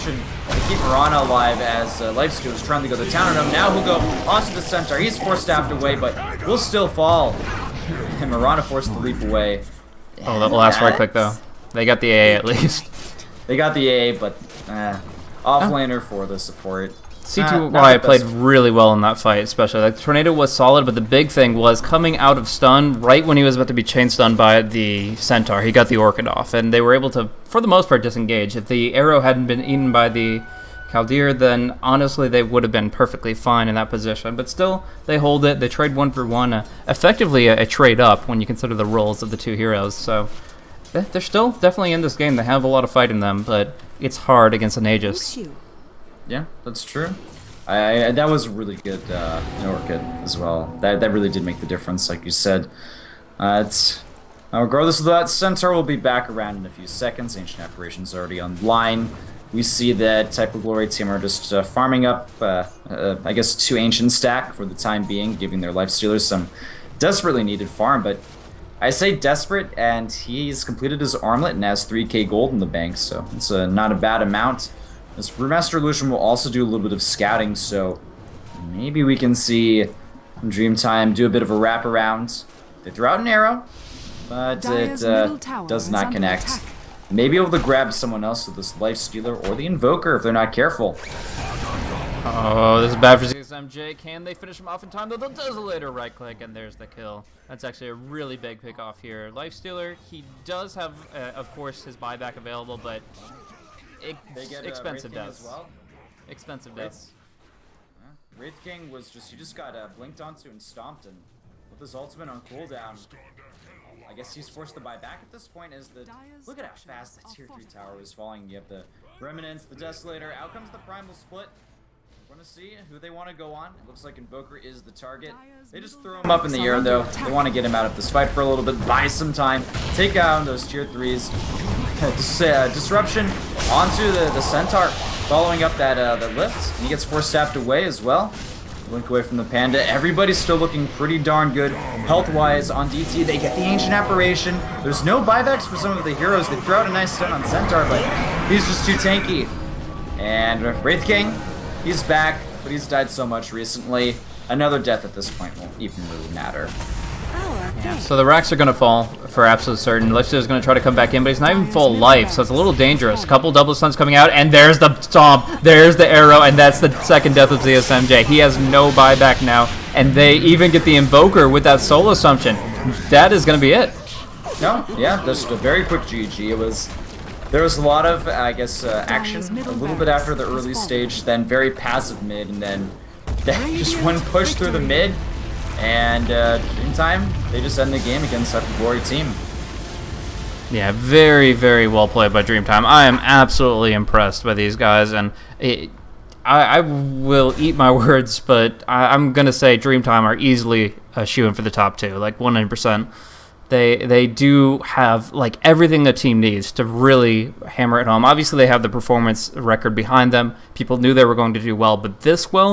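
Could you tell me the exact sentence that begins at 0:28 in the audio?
If the arrow hadn't been eaten by the Caldeer, then honestly they would have been perfectly fine in that position.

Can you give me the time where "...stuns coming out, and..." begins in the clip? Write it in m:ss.
2:43.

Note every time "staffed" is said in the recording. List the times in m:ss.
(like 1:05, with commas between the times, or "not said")
0:05, 2:17.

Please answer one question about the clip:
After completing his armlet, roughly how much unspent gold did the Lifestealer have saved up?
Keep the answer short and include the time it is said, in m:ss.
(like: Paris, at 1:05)
3k, at 1:11.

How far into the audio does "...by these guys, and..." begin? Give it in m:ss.
3:14.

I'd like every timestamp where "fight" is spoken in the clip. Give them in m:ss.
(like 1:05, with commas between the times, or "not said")
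0:19, 0:42, 2:08.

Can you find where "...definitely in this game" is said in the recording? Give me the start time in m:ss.
0:41.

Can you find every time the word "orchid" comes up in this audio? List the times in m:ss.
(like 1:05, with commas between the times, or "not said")
0:25, 0:49.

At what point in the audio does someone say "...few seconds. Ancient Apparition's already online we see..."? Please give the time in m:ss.
0:56.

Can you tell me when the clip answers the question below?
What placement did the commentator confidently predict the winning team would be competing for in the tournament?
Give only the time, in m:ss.
3:21.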